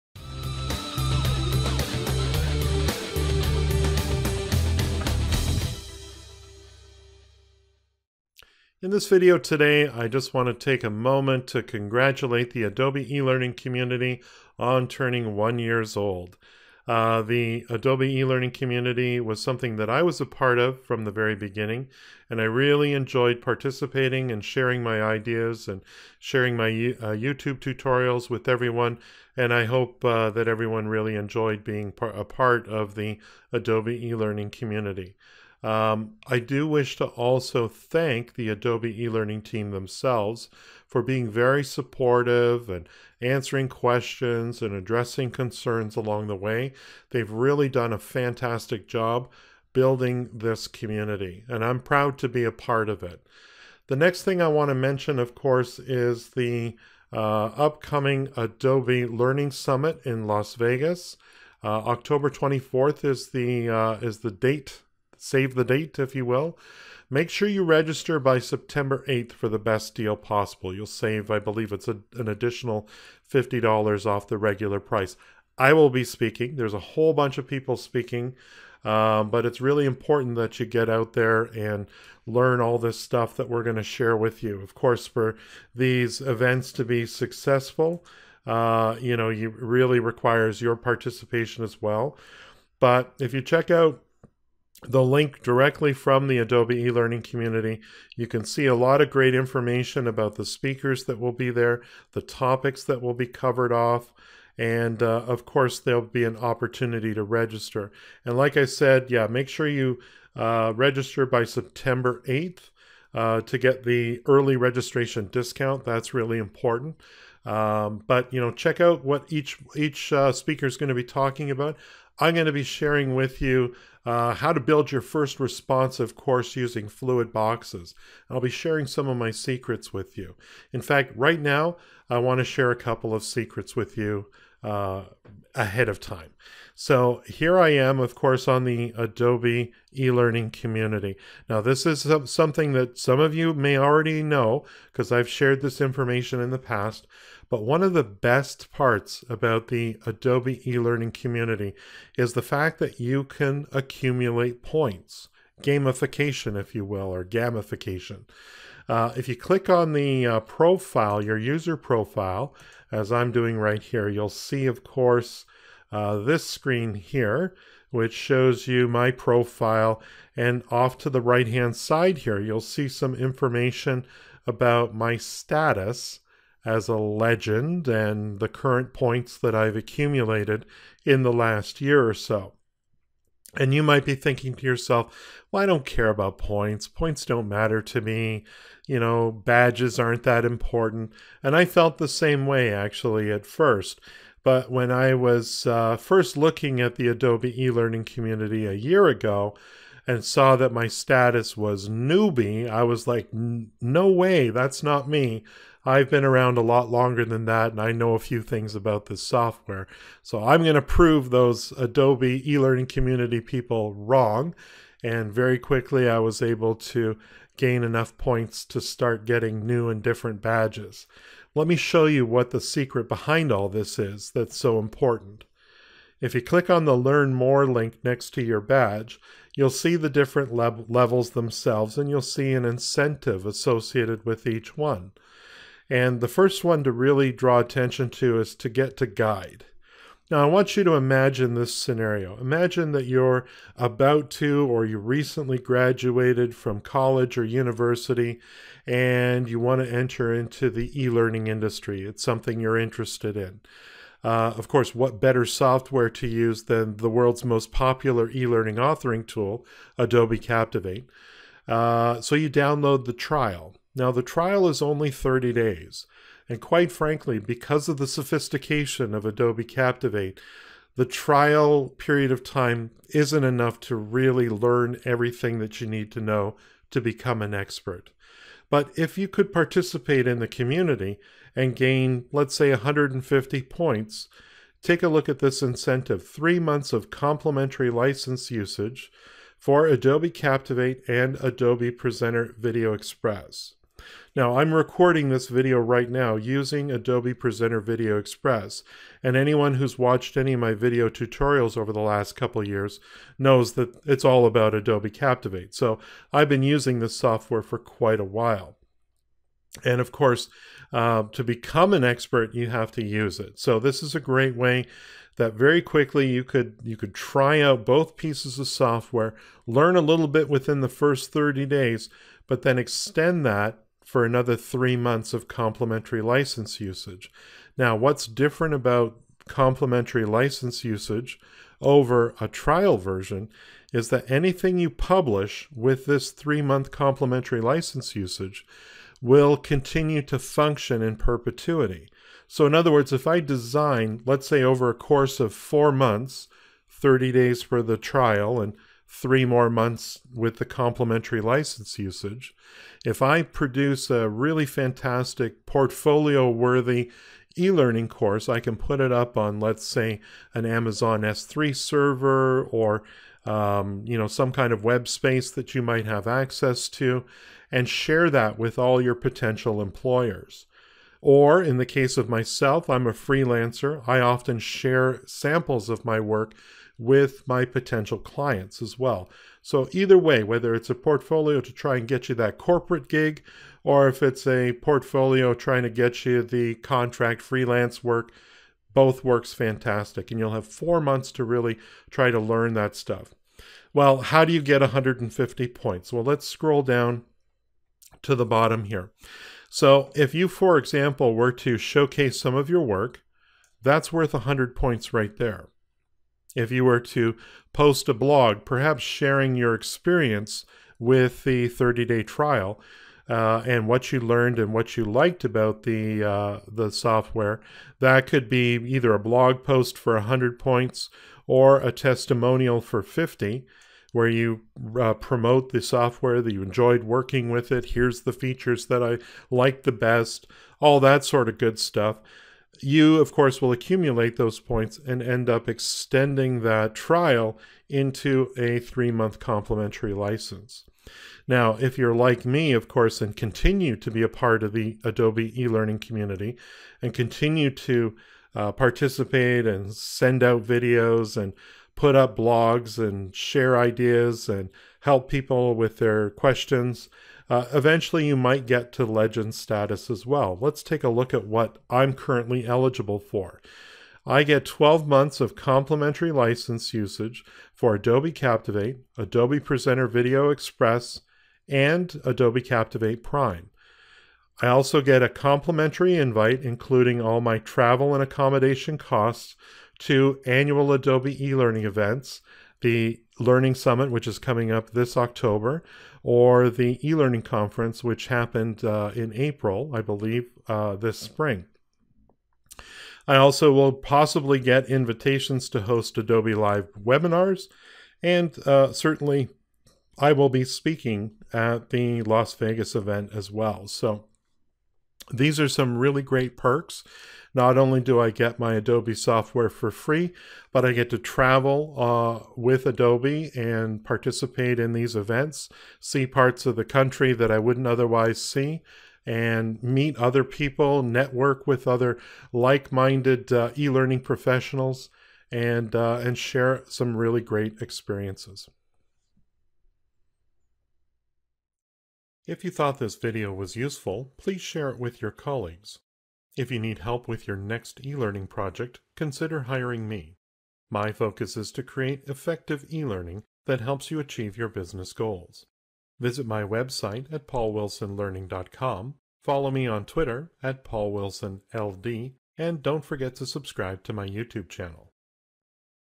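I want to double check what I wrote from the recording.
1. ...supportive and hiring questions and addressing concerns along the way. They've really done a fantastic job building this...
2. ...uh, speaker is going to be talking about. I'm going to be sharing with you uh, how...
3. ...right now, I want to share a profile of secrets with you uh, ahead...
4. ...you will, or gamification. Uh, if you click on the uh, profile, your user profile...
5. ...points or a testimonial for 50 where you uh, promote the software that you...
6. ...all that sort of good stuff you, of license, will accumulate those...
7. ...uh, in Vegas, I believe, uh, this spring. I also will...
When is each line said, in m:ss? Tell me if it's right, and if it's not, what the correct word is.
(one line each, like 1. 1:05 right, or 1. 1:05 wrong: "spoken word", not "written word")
1. 0:41 wrong: "answering", not "hiring"
2. 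2:00 right
3. 2:11 wrong: "couple", not "profile"
4. 2:36 right
5. 7:00 right
6. 7:10 wrong: "course", not "license"
7. 8:08 wrong: "April", not "Vegas".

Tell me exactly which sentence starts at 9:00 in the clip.
My focus is to create effective e-learning that helps you achieve your business goals.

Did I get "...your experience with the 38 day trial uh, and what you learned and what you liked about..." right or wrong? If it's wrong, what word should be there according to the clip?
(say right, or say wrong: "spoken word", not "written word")
wrong: "30", not "38".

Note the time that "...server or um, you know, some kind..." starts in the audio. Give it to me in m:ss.
6:01.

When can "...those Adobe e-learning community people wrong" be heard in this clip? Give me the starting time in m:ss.
3:31.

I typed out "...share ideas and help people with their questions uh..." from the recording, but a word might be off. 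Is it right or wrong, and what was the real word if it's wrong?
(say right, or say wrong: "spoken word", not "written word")
right.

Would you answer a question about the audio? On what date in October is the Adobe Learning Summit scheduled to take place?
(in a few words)
October 24.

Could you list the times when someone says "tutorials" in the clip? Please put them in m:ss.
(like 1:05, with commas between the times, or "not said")
0:27, 5:01.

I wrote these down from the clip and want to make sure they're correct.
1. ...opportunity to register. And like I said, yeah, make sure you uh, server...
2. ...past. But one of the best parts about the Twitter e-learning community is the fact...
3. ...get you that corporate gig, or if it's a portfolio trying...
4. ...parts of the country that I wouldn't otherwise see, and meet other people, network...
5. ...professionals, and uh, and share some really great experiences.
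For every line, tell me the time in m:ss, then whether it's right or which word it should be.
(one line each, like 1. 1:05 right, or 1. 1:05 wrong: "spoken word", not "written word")
1. 1:46 wrong: "register", not "server"
2. 2:26 wrong: "Adobe", not "Twitter"
3. 6:22 right
4. 8:36 right
5. 8:44 right.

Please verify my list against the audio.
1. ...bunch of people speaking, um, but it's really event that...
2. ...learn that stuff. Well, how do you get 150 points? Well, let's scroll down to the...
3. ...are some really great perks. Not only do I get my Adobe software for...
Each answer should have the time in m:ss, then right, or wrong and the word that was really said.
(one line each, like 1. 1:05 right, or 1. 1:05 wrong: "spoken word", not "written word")
1. 1:17 wrong: "important", not "event"
2. 6:32 right
3. 8:25 right.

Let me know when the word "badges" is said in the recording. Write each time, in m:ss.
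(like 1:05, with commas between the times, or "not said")
3:09, 3:40, 3:48.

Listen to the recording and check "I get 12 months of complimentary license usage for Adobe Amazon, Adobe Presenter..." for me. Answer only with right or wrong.
wrong.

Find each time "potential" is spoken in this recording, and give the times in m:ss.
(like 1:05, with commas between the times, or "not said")
6:09, 6:17.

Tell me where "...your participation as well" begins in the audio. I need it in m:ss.
1:30.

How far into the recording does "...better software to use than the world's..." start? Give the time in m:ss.
4:15.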